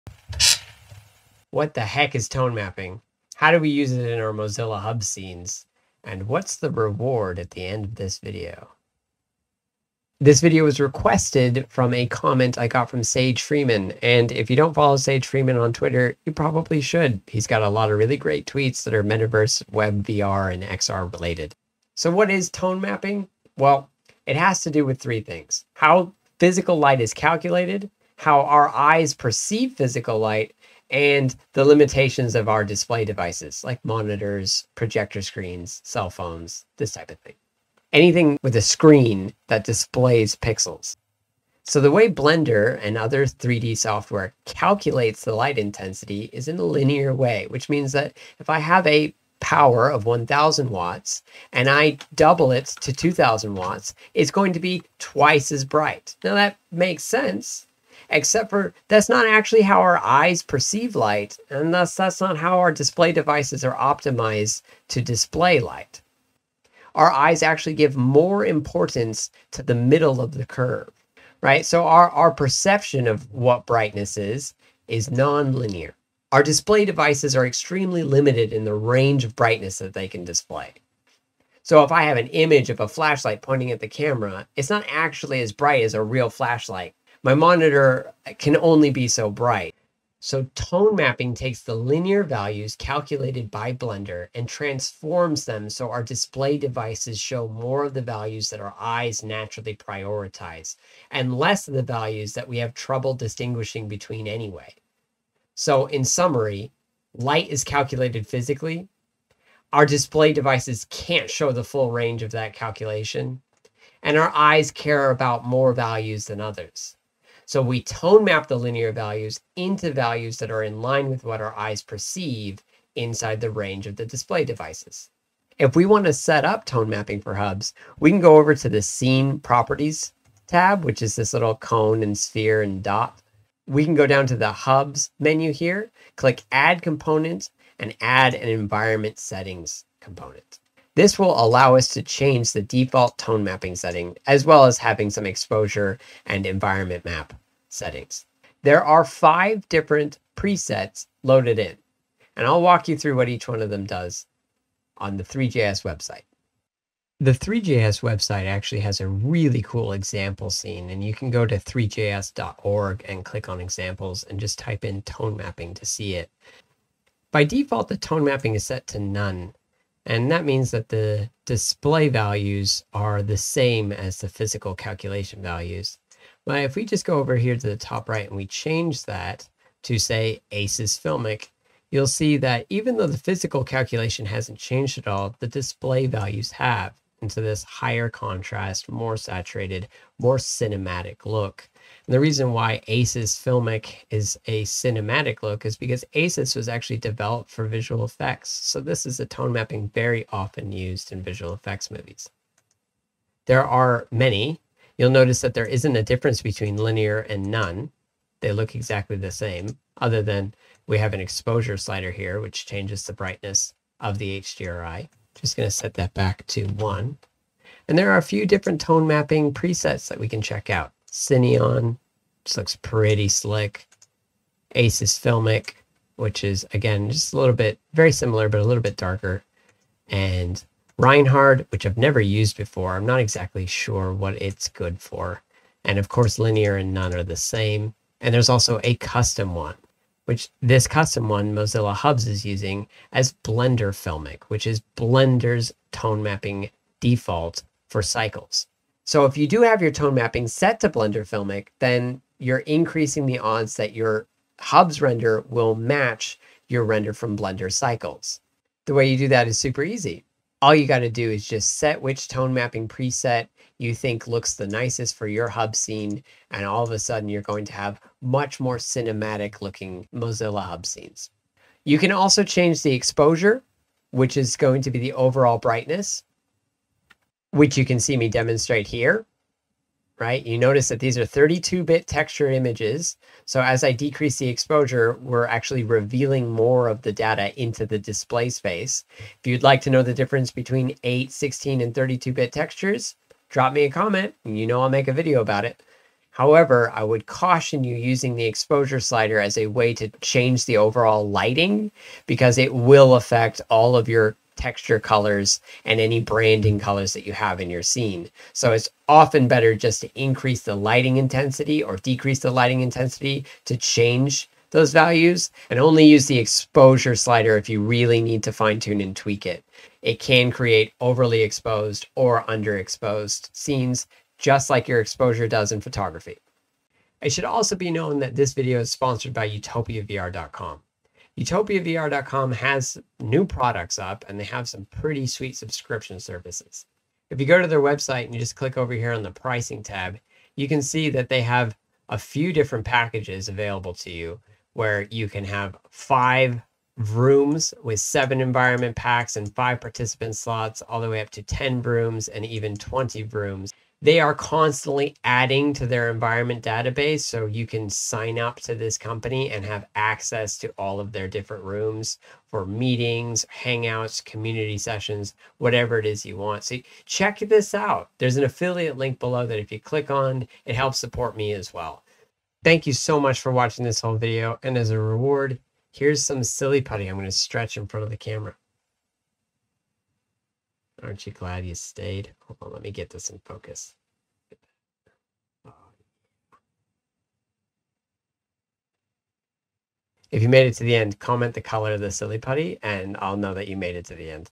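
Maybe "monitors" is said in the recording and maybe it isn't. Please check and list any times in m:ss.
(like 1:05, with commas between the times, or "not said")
0:33, 1:27.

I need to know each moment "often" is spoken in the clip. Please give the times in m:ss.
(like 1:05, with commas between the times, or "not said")
3:20, 5:09.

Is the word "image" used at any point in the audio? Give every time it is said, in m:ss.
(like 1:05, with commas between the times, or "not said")
1:22, 4:42.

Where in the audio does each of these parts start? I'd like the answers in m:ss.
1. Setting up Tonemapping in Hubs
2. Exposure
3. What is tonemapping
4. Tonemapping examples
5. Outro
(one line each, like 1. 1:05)
1. 2:04
2. 4:38
3. 0:21
4. 2:36
5. 5:30.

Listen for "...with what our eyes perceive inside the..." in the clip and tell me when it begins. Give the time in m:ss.
2:01.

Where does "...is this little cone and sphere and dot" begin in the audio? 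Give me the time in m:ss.
2:11.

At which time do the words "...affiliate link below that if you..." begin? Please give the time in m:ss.
6:08.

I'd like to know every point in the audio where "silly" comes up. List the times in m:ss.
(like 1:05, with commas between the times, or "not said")
6:16, 6:32.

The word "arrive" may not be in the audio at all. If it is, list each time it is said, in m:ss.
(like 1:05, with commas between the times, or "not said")
not said.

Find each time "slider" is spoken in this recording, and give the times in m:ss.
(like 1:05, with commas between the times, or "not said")
3:31, 4:58, 5:17.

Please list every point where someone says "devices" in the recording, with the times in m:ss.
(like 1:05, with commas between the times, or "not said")
0:33, 1:03, 1:16, 1:36, 1:50, 2:04.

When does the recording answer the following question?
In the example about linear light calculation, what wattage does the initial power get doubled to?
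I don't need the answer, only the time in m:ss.
0:52.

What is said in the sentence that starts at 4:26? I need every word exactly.
And all of a sudden, you're going to have much more cinematic looking Mozilla hub scenes.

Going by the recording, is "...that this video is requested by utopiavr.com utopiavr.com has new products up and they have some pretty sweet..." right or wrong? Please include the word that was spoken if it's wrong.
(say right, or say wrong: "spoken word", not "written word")
wrong: "sponsored", not "requested".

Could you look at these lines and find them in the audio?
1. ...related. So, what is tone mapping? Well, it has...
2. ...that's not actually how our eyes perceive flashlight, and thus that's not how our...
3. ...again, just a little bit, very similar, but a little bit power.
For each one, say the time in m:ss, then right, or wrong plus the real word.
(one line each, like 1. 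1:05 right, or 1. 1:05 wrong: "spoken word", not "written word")
1. 0:21 right
2. 0:58 wrong: "light", not "flashlight"
3. 3:46 wrong: "darker", not "power".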